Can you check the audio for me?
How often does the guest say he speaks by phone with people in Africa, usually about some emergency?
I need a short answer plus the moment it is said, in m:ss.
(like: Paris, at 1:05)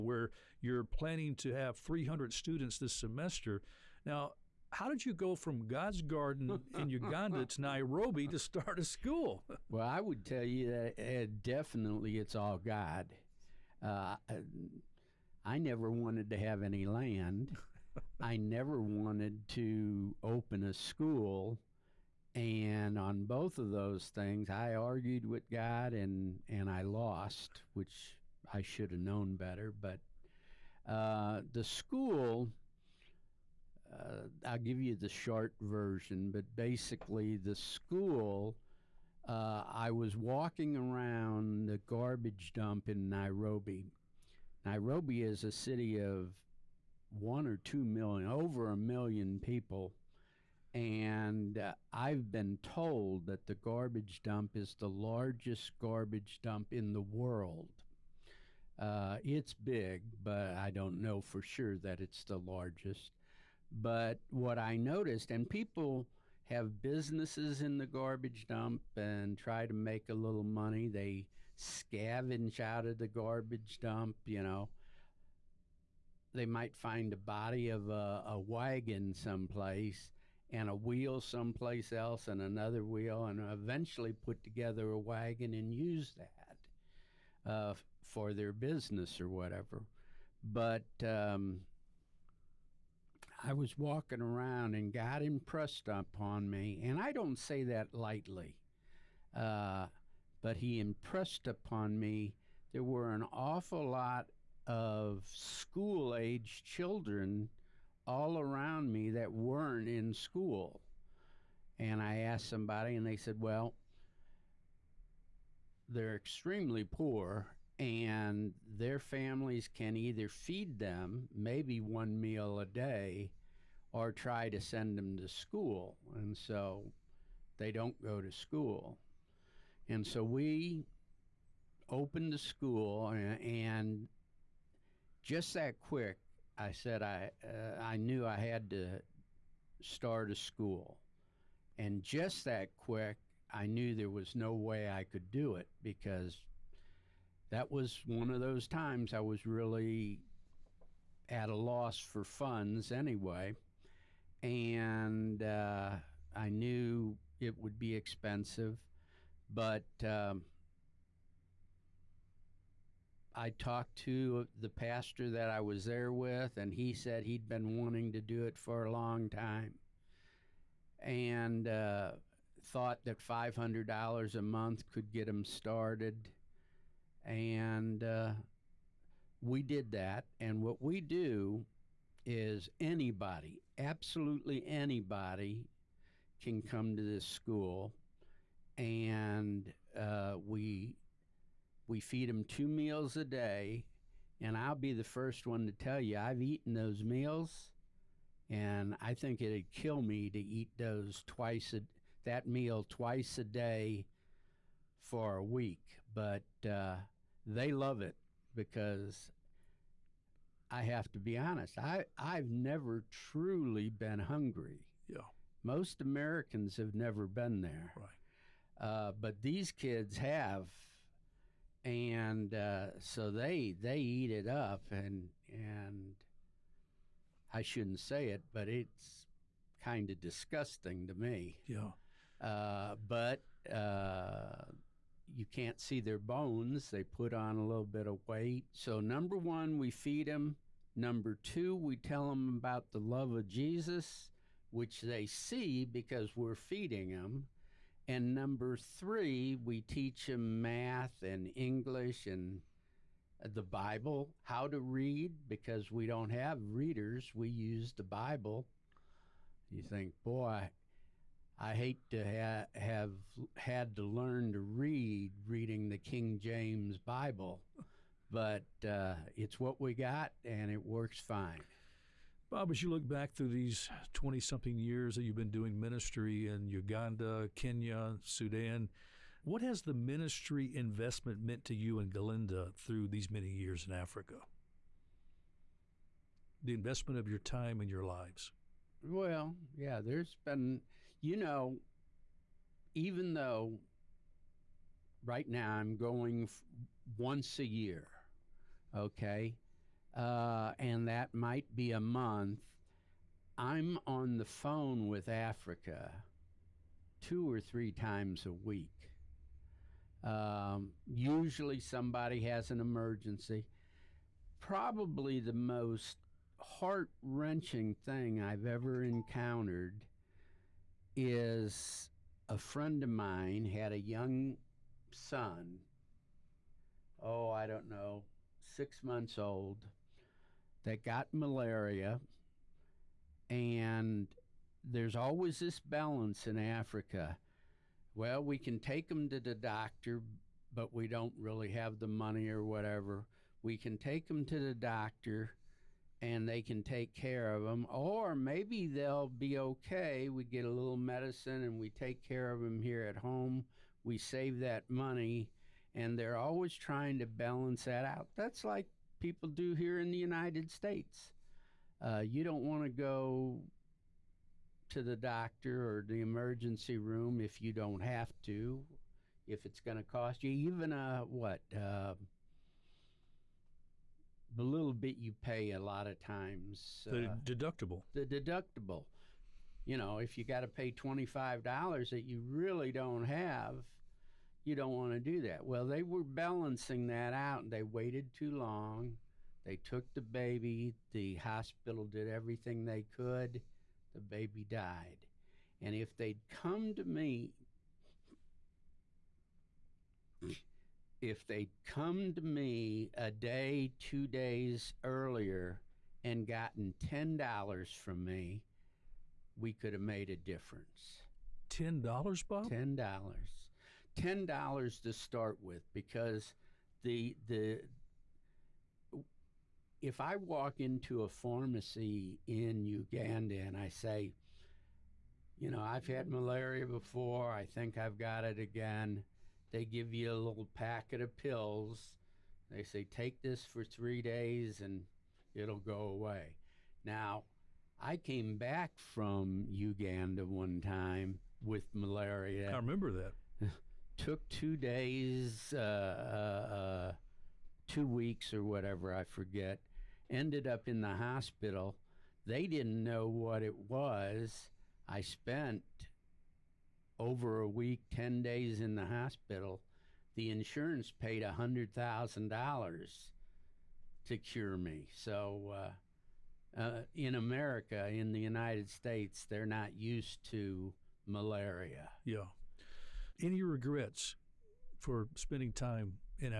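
2 or 3 times a week, at 5:07.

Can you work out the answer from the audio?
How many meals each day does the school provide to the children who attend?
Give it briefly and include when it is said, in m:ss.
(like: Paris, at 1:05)
2, at 3:12.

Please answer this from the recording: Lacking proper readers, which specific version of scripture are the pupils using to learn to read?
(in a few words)
King James Bible.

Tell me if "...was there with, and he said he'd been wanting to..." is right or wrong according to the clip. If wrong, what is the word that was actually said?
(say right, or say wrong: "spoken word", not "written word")
right.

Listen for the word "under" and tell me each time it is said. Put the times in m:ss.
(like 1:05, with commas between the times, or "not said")
not said.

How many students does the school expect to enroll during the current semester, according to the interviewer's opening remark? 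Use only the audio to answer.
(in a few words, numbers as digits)
300.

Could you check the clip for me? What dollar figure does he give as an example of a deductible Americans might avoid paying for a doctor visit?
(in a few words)
$25.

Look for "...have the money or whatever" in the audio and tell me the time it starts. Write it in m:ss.
5:41.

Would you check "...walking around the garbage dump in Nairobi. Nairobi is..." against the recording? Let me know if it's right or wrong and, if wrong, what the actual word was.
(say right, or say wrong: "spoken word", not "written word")
right.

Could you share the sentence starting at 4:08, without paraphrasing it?
And number three, we teach them math and English and uh, the Bible, how to read, because we don't have readers.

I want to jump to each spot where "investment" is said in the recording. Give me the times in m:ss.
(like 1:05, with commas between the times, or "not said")
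4:40, 4:46.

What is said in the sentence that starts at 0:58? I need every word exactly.
Uh, it's big, but I don't know for sure that it's the largest.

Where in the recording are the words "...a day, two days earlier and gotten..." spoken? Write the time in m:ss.
6:43.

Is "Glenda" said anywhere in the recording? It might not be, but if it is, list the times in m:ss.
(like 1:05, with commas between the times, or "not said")
4:42.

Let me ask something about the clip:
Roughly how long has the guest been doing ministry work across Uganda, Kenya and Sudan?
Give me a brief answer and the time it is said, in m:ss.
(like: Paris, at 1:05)
20-something years, at 4:34.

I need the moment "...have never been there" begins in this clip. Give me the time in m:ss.
3:36.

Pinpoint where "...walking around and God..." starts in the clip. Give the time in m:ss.
1:33.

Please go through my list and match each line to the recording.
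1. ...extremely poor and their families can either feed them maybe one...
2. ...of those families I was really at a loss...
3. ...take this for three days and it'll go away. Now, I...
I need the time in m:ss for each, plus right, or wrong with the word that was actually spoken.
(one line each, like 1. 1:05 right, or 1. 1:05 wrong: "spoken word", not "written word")
1. 1:56 right
2. 2:28 wrong: "times", not "families"
3. 7:13 right.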